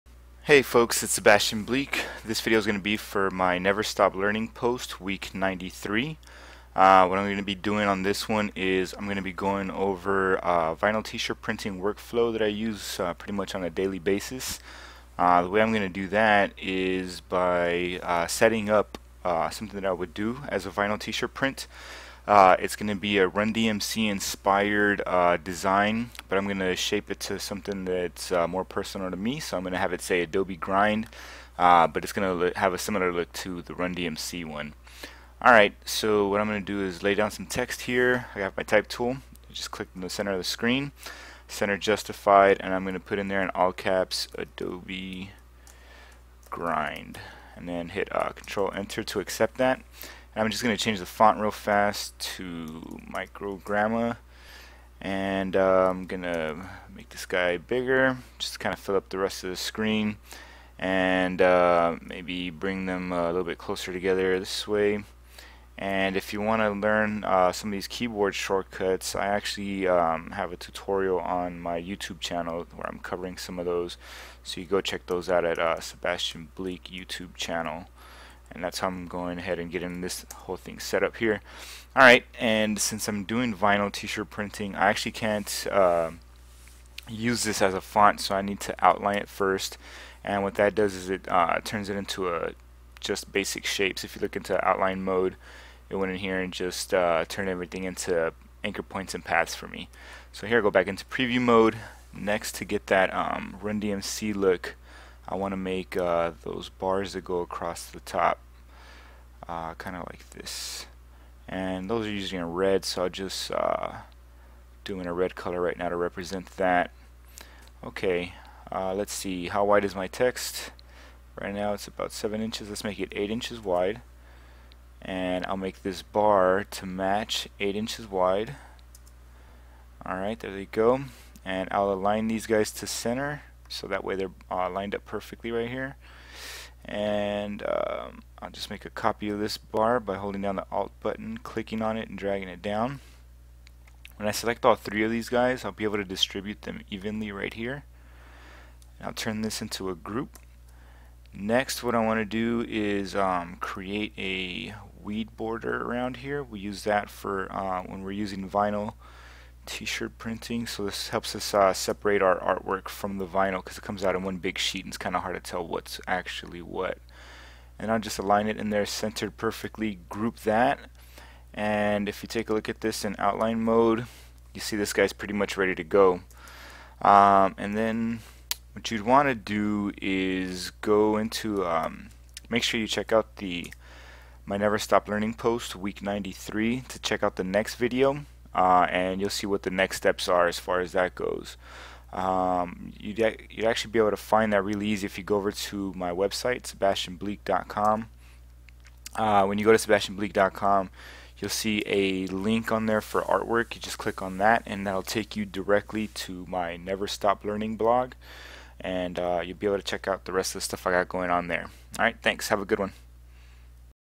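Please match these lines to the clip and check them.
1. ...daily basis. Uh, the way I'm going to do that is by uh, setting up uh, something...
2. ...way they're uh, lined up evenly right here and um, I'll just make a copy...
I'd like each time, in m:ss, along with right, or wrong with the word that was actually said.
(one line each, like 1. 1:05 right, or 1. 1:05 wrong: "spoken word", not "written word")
1. 0:13 right
2. 2:14 wrong: "perfectly", not "evenly".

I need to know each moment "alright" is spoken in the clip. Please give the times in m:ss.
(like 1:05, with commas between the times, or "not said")
0:35, 1:21, 2:10.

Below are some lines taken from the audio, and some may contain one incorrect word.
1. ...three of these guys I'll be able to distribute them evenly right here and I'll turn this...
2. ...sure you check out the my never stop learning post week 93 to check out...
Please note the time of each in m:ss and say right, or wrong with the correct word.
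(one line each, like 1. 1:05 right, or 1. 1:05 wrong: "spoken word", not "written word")
1. 2:24 right
2. 3:02 right.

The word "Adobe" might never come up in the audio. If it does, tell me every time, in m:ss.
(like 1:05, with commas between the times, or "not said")
0:30, 0:44.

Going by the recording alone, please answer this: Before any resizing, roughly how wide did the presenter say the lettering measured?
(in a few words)
7 inches.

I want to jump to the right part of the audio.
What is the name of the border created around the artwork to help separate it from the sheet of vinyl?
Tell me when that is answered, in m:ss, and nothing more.
2:35.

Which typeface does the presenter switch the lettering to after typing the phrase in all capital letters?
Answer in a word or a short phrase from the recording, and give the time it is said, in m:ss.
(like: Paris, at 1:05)
Microgramma, at 0:53.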